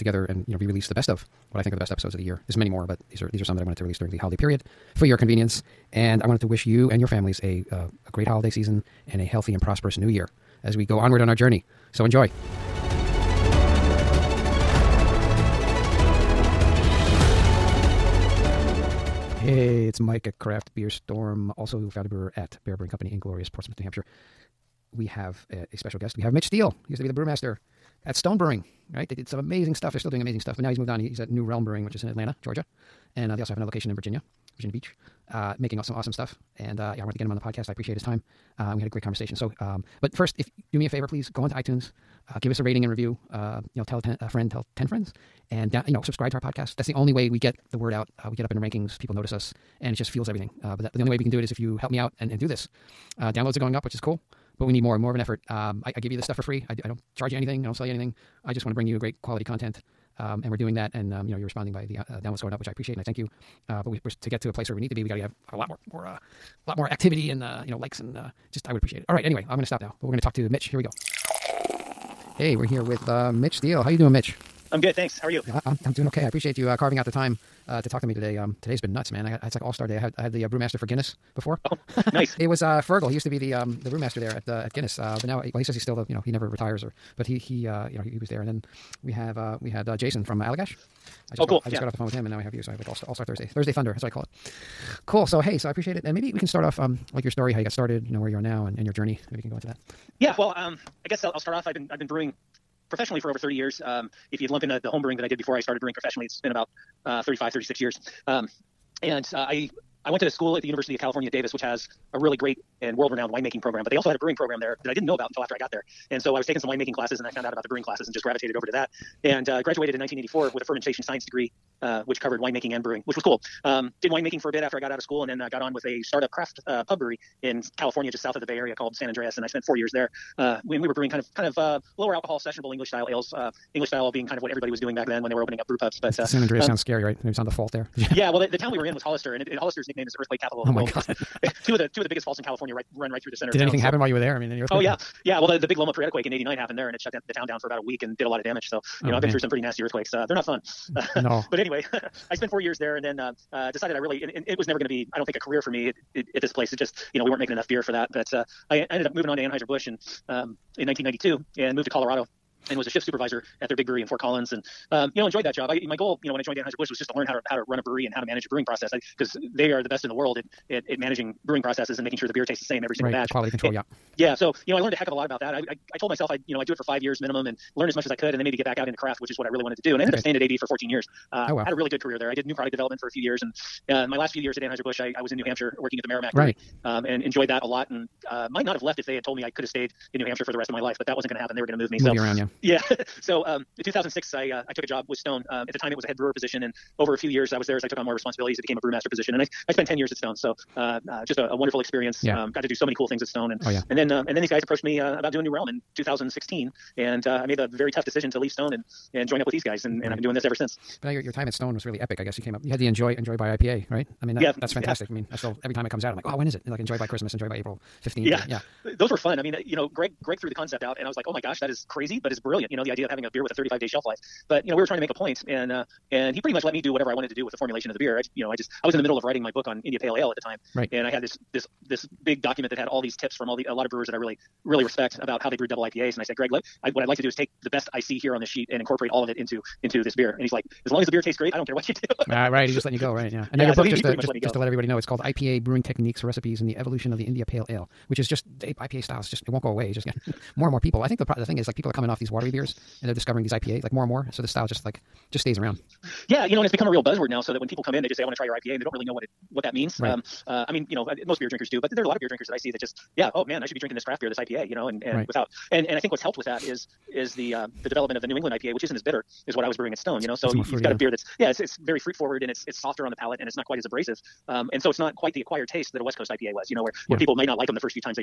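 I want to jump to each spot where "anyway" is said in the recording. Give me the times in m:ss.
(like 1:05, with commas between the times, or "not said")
1:09, 2:31.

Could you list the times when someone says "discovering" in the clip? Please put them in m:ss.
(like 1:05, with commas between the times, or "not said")
4:13.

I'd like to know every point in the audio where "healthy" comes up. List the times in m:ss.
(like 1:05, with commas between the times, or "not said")
0:09.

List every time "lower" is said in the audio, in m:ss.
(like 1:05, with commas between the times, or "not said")
2:11.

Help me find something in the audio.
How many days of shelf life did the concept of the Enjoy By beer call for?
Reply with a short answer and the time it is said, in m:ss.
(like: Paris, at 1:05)
35, at 3:43.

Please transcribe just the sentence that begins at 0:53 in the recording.
Uh, downloads are going up, which is cool, but we need more more of an effort.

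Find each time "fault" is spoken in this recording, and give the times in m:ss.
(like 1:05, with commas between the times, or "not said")
2:17, 2:22.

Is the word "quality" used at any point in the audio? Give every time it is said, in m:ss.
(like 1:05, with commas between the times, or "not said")
0:59, 2:53.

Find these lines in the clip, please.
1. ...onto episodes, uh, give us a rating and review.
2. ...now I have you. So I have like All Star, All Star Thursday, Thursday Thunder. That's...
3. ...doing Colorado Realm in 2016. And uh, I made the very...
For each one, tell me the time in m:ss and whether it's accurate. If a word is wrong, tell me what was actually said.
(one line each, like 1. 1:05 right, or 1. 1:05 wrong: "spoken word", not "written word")
1. 0:41 wrong: "iTunes", not "episodes"
2. 1:32 right
3. 3:25 wrong: "New", not "Colorado".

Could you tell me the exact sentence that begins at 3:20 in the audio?
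So uh, uh, just a, a, wonderful experience.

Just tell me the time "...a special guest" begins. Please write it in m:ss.
0:25.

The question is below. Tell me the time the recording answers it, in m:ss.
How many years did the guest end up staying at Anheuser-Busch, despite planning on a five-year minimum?
3:00.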